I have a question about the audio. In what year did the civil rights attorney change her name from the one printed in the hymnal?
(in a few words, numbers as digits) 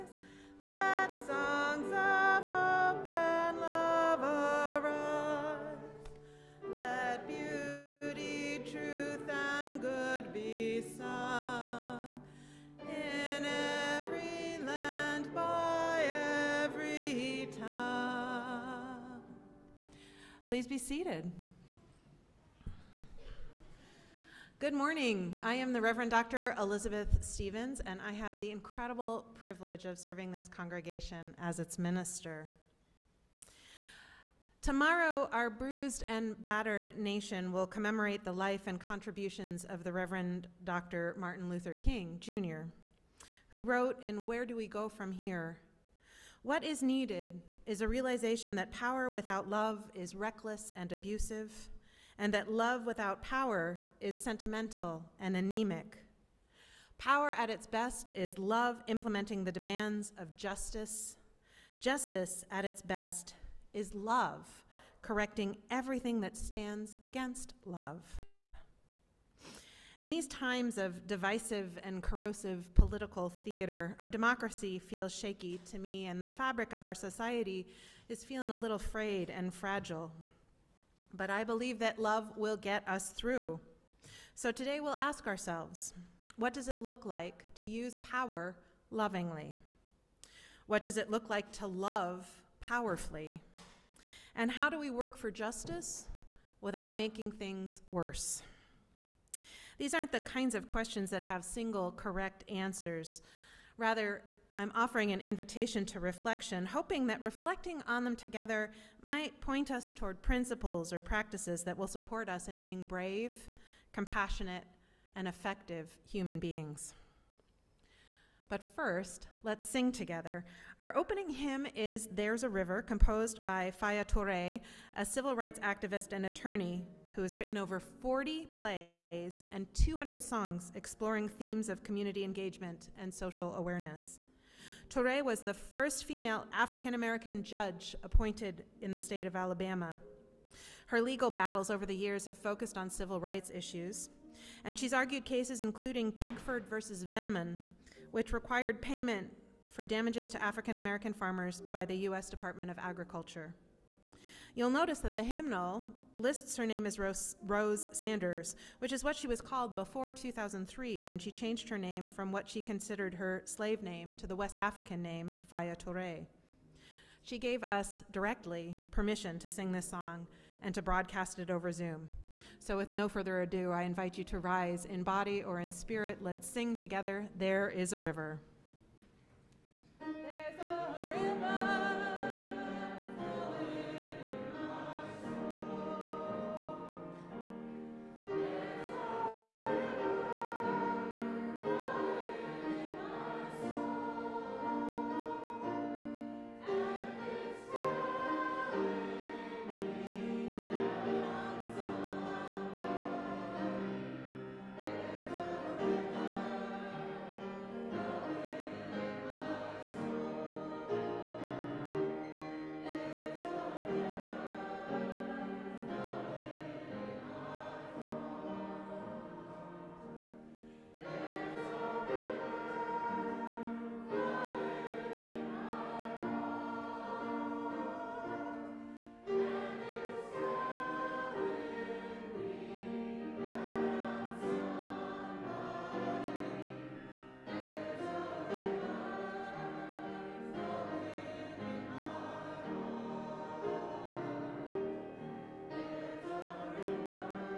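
2003.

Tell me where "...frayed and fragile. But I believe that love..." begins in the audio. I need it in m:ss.
1:18.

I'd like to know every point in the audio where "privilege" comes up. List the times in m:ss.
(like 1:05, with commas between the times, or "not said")
0:29.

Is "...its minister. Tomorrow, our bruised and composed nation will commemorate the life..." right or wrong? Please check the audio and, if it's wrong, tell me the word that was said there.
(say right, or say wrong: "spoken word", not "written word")
wrong: "battered", not "composed".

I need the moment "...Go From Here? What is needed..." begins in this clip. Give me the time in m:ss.
0:44.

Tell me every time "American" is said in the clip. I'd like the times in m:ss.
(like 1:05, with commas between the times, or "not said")
2:16, 2:30.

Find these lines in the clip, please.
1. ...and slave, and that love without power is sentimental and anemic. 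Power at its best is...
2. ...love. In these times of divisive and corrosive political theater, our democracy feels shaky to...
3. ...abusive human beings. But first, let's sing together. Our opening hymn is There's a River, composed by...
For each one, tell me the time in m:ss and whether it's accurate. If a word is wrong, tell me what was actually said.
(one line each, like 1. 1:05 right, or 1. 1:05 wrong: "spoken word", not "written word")
1. 0:50 wrong: "abusive", not "slave"
2. 1:07 right
3. 1:55 wrong: "effective", not "abusive".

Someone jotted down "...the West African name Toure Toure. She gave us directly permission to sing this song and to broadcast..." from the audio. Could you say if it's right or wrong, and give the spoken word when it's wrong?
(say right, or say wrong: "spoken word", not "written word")
wrong: "Faya", not "Toure".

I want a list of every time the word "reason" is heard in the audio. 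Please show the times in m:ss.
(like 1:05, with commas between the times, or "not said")
not said.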